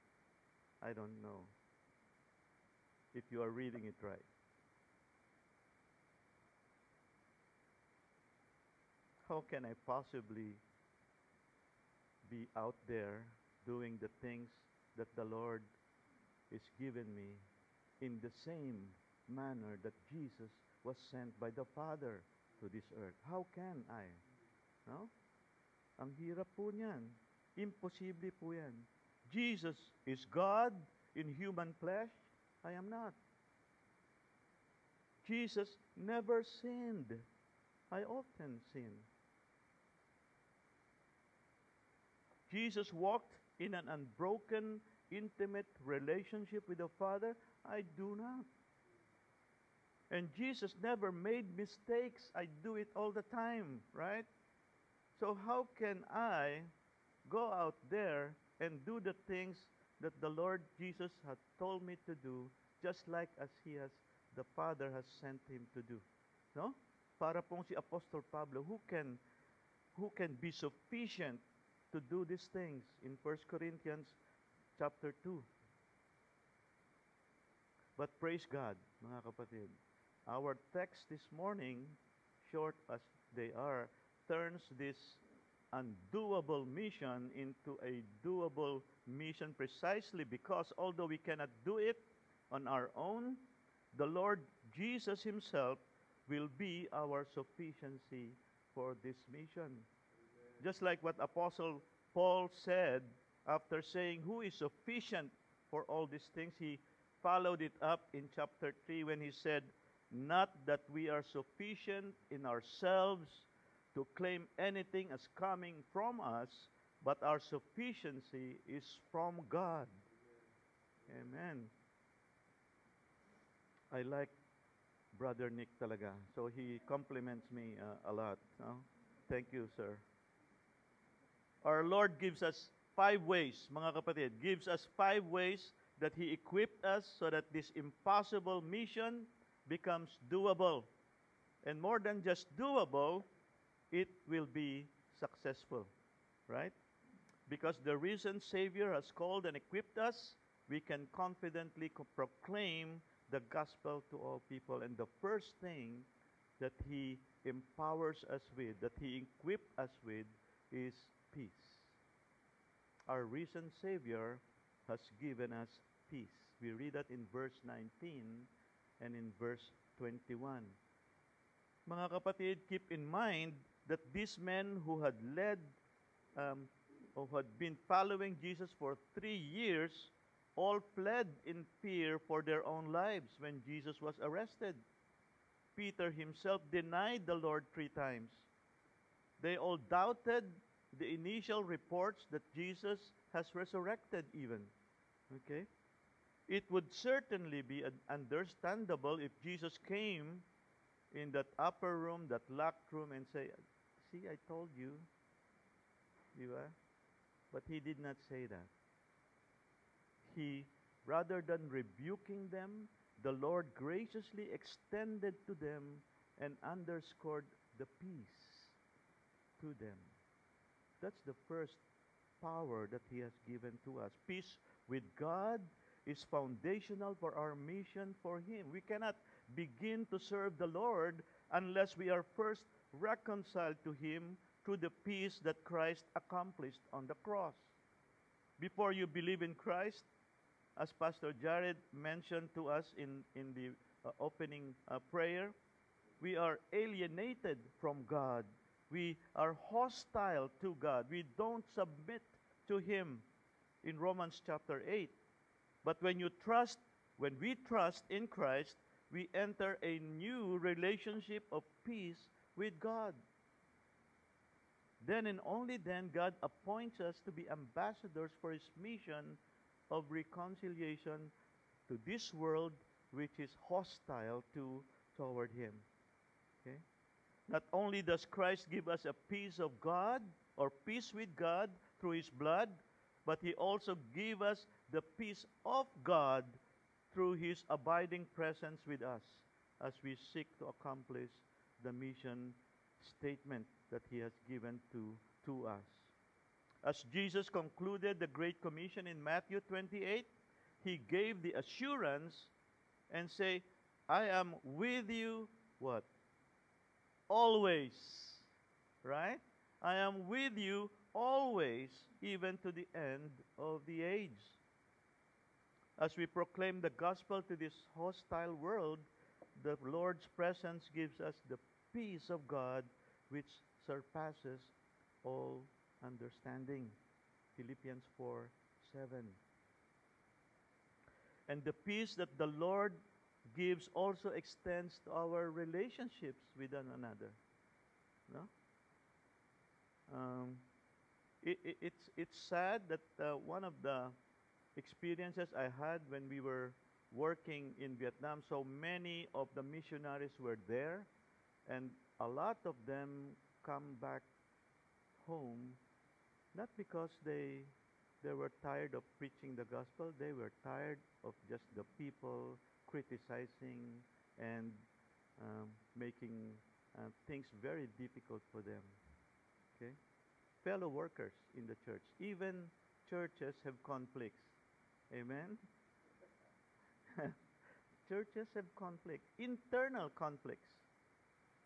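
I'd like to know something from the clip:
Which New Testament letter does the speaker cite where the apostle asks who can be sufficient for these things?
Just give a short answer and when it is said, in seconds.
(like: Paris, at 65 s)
1 Corinthians, at 73 s.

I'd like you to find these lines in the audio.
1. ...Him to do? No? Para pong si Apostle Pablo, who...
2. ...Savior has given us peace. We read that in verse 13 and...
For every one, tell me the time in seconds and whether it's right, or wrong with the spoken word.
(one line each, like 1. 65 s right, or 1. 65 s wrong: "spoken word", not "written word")
1. 65 s right
2. 163 s wrong: "19", not "13".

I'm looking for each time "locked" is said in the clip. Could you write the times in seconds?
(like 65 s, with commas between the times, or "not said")
202 s.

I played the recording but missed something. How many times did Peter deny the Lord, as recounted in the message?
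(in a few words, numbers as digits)
3.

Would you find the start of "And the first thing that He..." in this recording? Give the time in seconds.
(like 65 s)
154 s.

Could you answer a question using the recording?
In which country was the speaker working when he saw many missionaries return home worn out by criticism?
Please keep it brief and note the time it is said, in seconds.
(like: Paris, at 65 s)
Vietnam, at 347 s.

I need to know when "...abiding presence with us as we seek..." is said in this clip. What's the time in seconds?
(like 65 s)
287 s.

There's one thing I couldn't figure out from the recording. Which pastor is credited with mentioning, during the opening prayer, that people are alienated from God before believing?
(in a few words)
Pastor Jared.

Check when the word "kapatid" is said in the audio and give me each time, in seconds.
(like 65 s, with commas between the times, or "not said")
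79 s, 133 s, 172 s.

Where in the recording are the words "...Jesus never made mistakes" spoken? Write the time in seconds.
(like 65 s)
50 s.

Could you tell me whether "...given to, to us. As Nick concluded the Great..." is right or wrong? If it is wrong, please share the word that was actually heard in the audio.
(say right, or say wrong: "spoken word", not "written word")
wrong: "Jesus", not "Nick".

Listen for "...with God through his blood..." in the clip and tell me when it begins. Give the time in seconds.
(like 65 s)
281 s.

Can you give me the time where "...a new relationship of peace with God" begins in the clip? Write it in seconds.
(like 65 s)
259 s.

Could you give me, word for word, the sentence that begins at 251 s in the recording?
We don't submit to Him in Romans chapter 8.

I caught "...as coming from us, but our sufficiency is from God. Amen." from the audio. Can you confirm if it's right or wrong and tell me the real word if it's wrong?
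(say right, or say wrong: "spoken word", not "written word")
right.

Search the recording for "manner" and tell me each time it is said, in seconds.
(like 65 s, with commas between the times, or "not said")
19 s.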